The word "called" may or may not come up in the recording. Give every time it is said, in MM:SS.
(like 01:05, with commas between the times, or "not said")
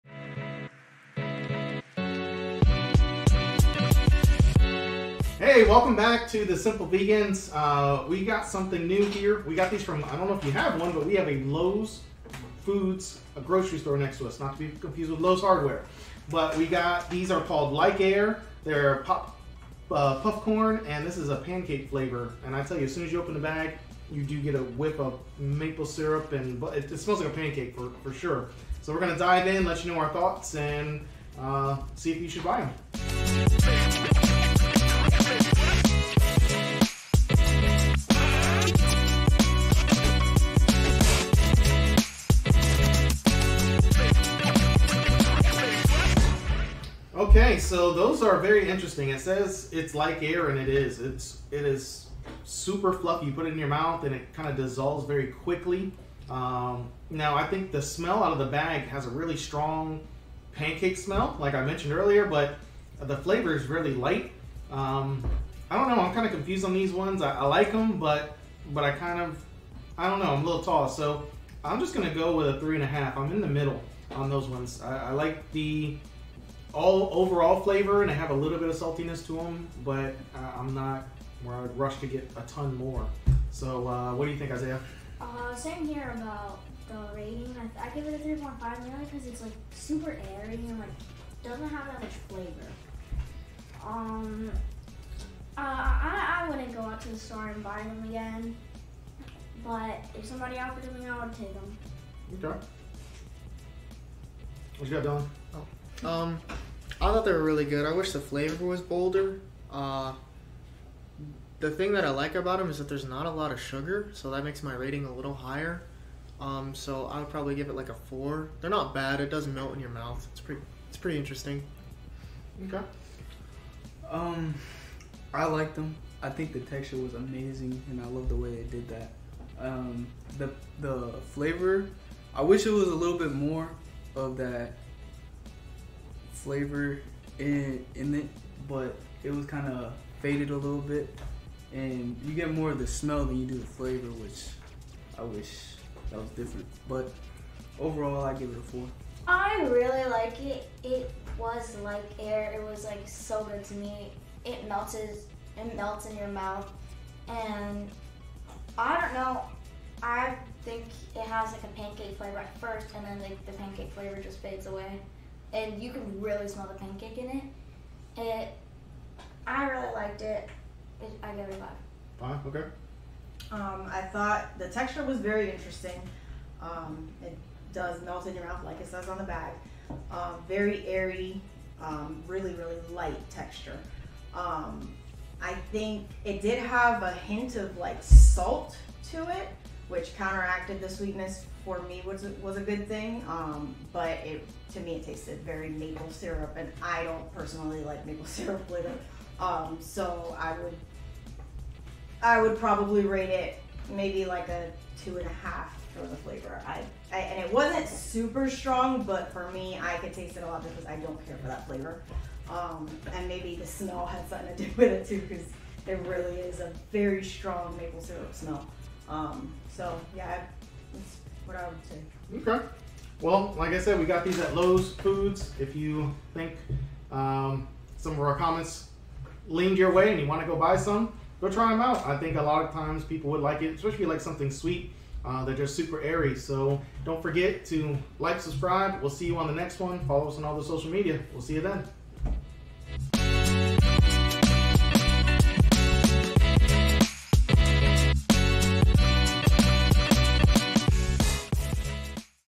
00:17.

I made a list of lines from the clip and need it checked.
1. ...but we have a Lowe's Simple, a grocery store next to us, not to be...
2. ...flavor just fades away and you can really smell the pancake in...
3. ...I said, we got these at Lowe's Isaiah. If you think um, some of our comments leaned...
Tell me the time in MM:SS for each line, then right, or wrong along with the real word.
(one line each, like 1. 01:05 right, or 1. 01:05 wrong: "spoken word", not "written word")
1. 00:10 wrong: "Foods", not "Simple"
2. 02:43 right
3. 03:43 wrong: "Foods", not "Isaiah".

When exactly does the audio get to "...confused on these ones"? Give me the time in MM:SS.
01:06.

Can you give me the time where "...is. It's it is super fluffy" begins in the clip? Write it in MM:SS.
00:50.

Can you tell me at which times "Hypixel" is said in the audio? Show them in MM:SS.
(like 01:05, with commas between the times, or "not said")
not said.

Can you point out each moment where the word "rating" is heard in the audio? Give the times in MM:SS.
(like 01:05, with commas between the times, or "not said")
01:27, 01:54.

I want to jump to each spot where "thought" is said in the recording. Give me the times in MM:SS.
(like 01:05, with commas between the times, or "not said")
00:30, 01:47, 02:54.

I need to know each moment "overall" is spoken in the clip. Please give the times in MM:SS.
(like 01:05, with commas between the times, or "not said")
01:17, 02:27.